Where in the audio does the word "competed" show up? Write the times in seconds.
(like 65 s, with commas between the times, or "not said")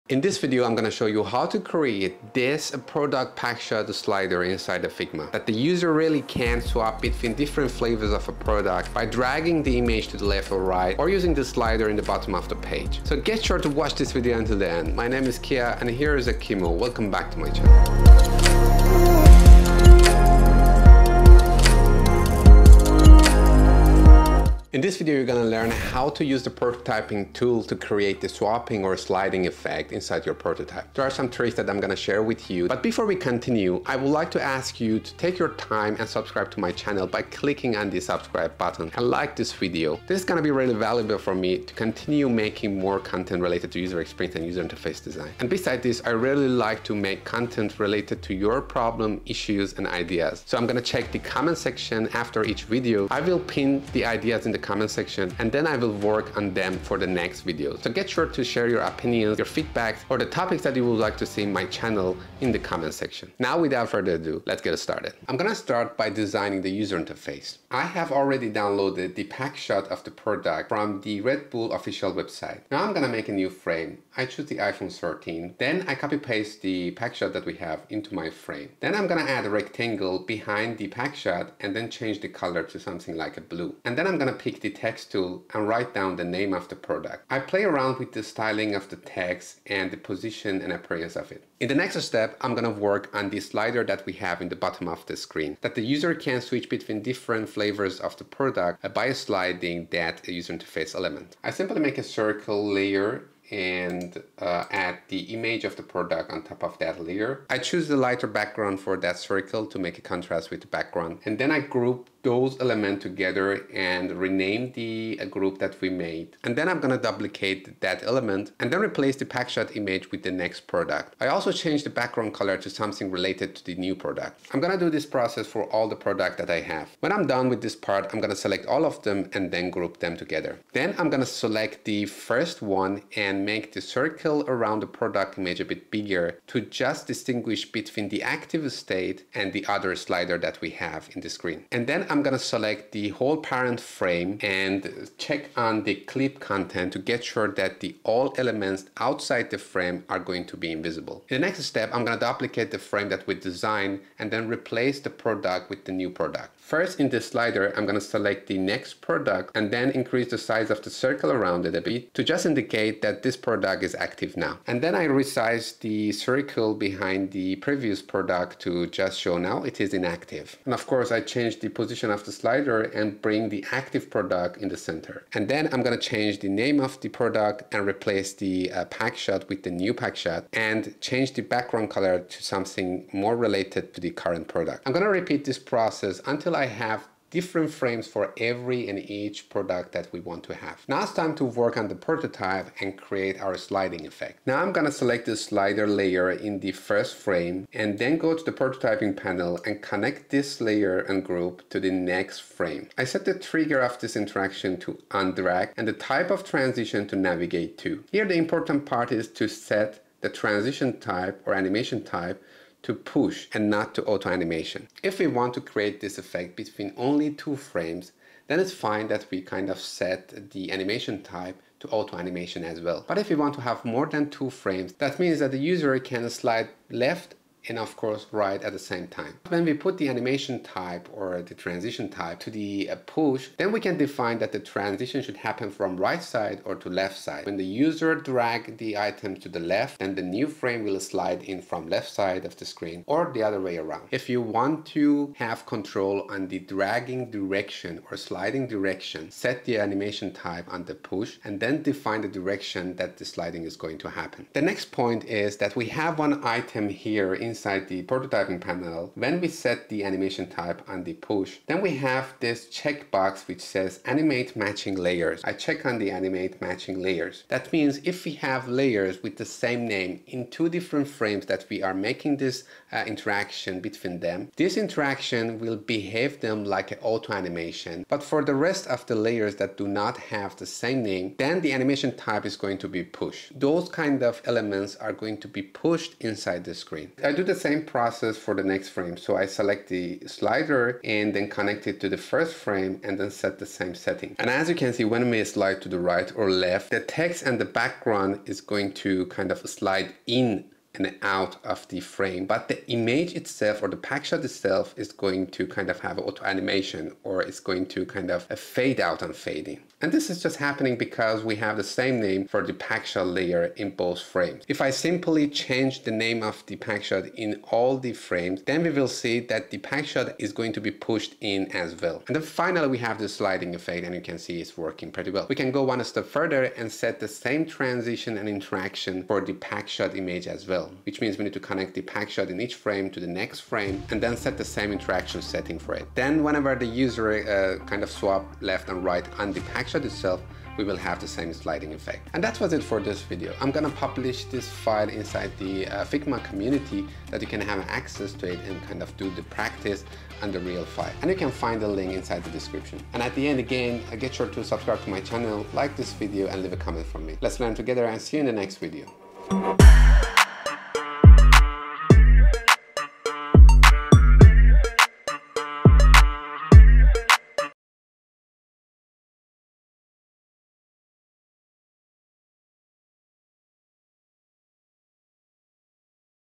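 not said.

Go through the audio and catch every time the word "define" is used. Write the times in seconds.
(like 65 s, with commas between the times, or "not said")
233 s, 251 s.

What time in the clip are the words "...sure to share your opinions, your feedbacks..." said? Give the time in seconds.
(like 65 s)
58 s.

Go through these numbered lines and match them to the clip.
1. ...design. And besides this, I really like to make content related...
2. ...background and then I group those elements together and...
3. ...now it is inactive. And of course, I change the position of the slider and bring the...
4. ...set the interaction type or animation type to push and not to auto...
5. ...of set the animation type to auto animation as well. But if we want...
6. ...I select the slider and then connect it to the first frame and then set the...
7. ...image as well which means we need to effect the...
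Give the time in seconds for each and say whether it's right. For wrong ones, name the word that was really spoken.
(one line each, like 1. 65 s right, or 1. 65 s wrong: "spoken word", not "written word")
1. 45 s right
2. 110 s right
3. 169 s right
4. 209 s wrong: "transition", not "interaction"
5. 219 s right
6. 289 s right
7. 330 s wrong: "connect", not "effect".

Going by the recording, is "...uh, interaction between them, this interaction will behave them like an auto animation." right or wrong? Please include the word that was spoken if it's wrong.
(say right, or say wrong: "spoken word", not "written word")
right.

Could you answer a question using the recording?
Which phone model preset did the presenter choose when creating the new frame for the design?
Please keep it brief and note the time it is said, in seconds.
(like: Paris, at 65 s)
iPhone 13, at 74 s.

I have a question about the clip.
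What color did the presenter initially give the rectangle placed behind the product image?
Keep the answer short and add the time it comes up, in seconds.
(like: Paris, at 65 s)
Blue, at 83 s.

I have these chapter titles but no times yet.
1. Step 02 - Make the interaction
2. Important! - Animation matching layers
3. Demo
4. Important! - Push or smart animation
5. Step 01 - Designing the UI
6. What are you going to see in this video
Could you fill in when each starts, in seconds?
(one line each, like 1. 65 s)
1. 191 s
2. 254 s
3. 325 s
4. 215 s
5. 65 s
6. 24 s.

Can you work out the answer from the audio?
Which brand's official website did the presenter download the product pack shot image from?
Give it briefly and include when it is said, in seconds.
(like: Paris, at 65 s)
Red Bull, at 71 s.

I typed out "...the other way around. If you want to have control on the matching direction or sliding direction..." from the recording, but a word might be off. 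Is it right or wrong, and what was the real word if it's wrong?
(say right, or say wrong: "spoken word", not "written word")
wrong: "dragging", not "matching".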